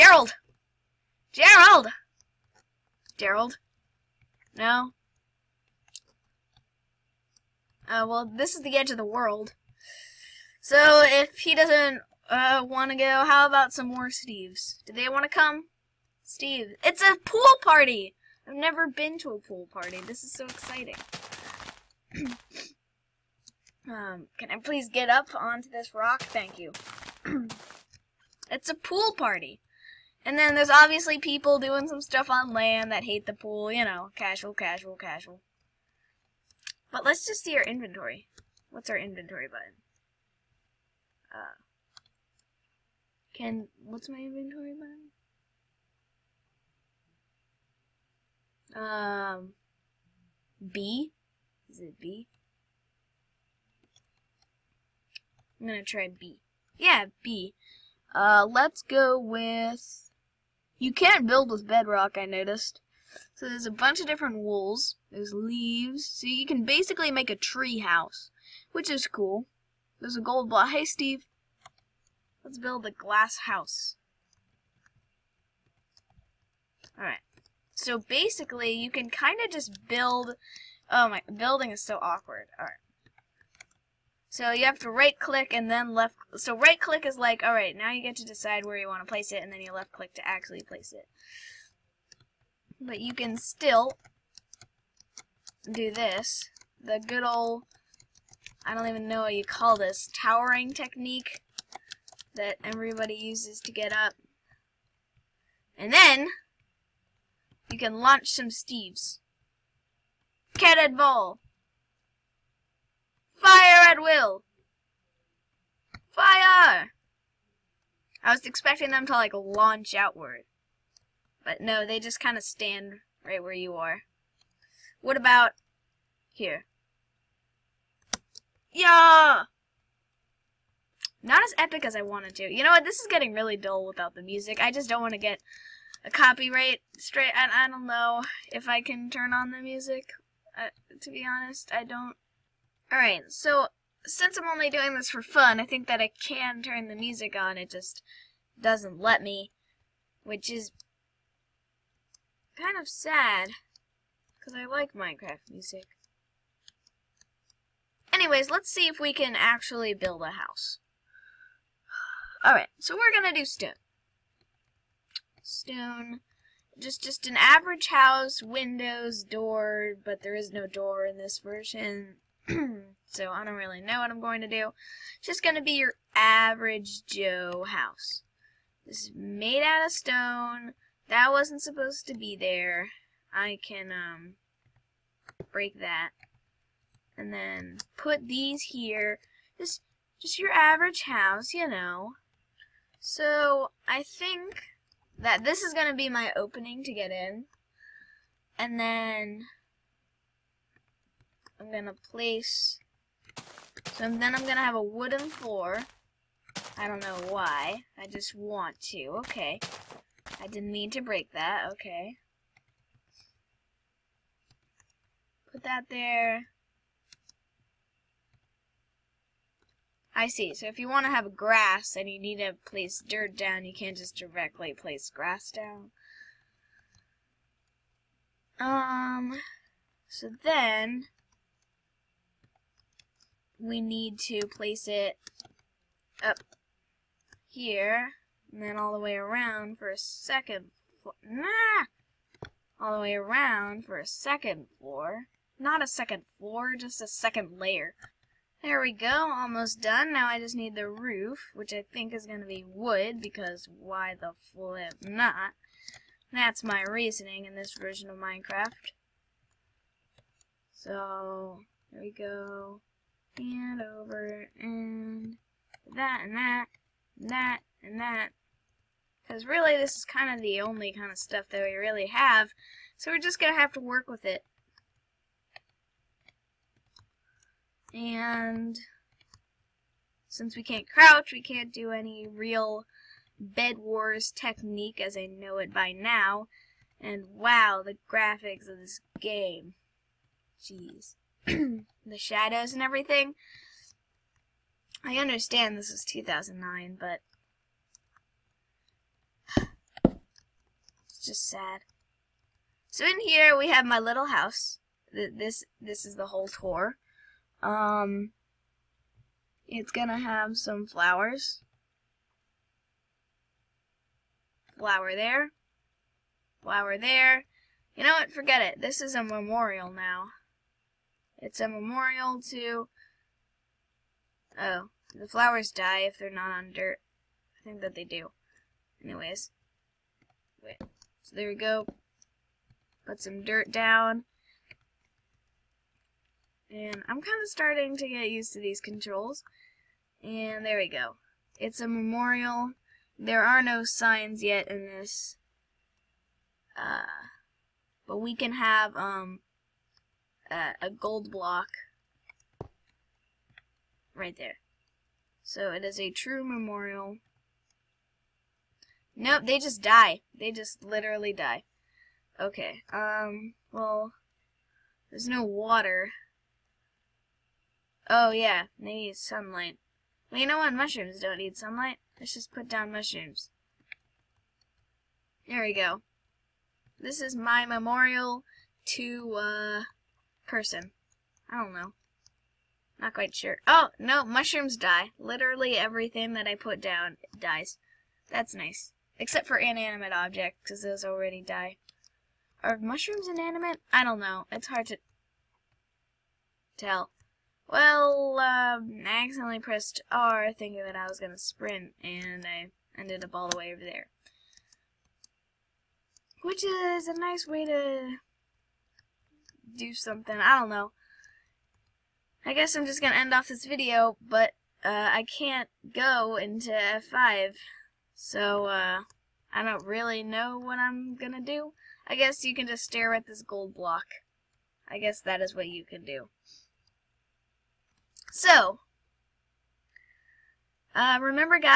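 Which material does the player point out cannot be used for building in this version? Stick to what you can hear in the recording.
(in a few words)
Bedrock.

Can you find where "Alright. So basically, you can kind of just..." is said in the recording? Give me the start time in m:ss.
1:16.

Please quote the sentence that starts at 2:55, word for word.
It's just going to be your average Joe house.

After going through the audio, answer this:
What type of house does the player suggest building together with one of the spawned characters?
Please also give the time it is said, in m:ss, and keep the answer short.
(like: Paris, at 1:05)
Glass house, at 1:12.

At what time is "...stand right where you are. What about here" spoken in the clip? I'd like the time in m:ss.
2:02.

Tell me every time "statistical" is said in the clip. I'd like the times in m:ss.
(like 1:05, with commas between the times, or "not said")
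not said.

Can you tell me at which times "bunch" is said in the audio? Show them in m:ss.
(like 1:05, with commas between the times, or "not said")
1:03.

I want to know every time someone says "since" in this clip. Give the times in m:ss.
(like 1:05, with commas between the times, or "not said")
2:24, 4:40.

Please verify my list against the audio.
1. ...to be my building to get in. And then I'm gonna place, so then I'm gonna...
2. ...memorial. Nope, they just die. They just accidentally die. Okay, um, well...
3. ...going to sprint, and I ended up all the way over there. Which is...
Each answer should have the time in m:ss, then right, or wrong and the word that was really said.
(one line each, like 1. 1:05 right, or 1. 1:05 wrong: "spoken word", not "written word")
1. 3:15 wrong: "opening", not "building"
2. 5:56 wrong: "literally", not "accidentally"
3. 6:41 right.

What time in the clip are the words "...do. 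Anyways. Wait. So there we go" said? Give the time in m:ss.
5:28.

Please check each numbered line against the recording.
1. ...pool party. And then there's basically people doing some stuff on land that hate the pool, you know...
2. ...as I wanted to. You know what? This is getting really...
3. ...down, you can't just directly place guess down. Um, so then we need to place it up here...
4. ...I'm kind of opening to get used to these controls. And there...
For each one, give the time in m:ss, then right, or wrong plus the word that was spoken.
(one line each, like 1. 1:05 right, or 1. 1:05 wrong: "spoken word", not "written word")
1. 0:28 wrong: "obviously", not "basically"
2. 2:11 right
3. 3:43 wrong: "grass", not "guess"
4. 5:37 wrong: "starting", not "opening".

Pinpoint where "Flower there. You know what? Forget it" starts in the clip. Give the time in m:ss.
5:16.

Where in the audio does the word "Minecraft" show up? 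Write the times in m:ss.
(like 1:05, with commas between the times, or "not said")
2:34, 4:18.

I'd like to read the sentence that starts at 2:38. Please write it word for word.
Anyways, let's see if we can actually build a house.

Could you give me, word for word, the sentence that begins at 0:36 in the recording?
But let's just see our inventory.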